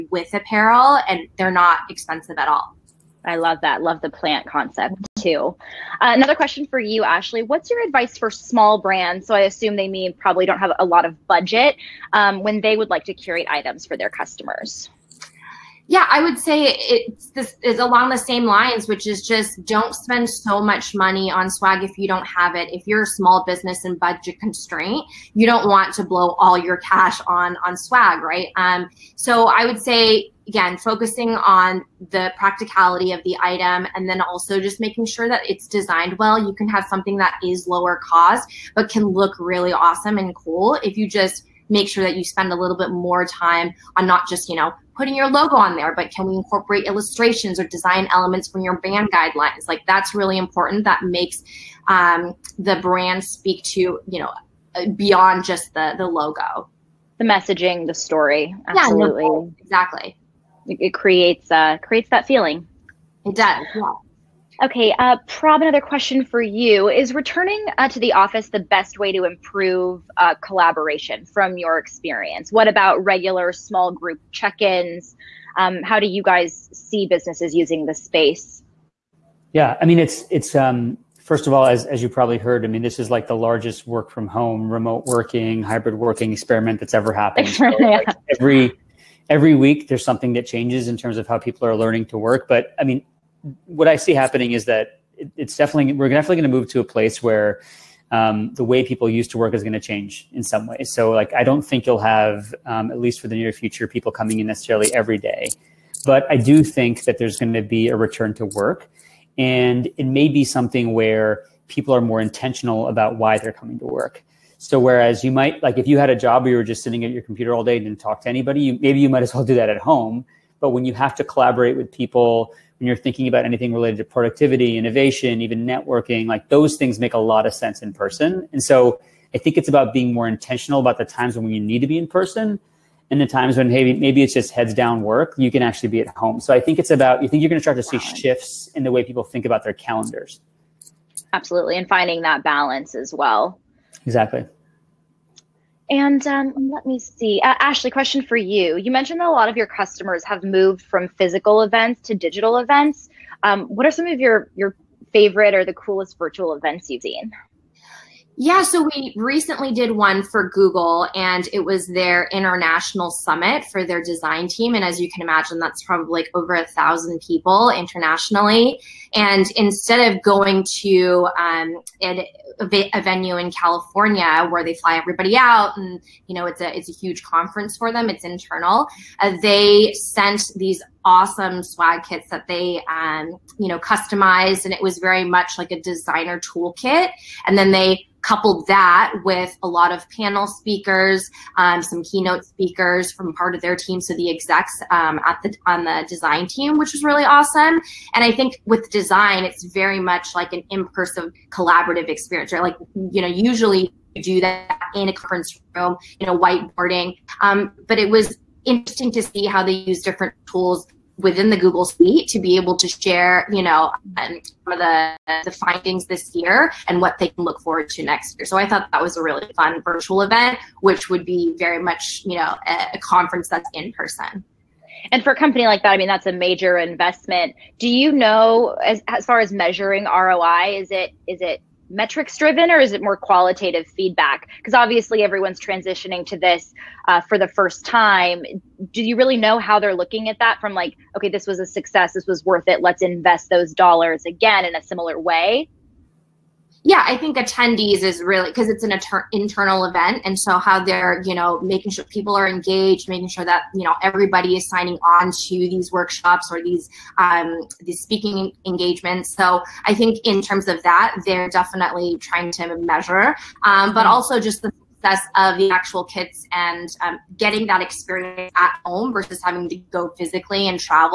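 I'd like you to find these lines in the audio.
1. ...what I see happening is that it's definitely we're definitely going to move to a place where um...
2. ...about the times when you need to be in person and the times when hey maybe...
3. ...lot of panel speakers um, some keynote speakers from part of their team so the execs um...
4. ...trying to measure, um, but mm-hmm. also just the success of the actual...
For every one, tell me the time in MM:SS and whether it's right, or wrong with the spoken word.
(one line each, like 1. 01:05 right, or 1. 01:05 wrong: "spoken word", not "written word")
1. 01:33 right
2. 02:10 right
3. 03:09 right
4. 04:22 right.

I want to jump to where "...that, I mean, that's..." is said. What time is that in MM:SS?
03:45.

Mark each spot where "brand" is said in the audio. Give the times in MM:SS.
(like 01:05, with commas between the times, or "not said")
00:08, 00:48, 00:52.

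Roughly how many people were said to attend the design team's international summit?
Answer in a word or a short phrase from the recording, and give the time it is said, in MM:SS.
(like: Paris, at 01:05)
over 1,000, at 02:46.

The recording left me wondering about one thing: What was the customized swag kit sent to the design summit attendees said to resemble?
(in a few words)
a designer toolkit.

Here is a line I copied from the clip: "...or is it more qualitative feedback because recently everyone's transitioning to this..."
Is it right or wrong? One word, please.
wrong.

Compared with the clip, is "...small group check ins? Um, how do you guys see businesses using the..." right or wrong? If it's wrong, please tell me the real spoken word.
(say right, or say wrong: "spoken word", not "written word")
right.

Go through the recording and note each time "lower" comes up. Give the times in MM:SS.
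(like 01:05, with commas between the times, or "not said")
00:37.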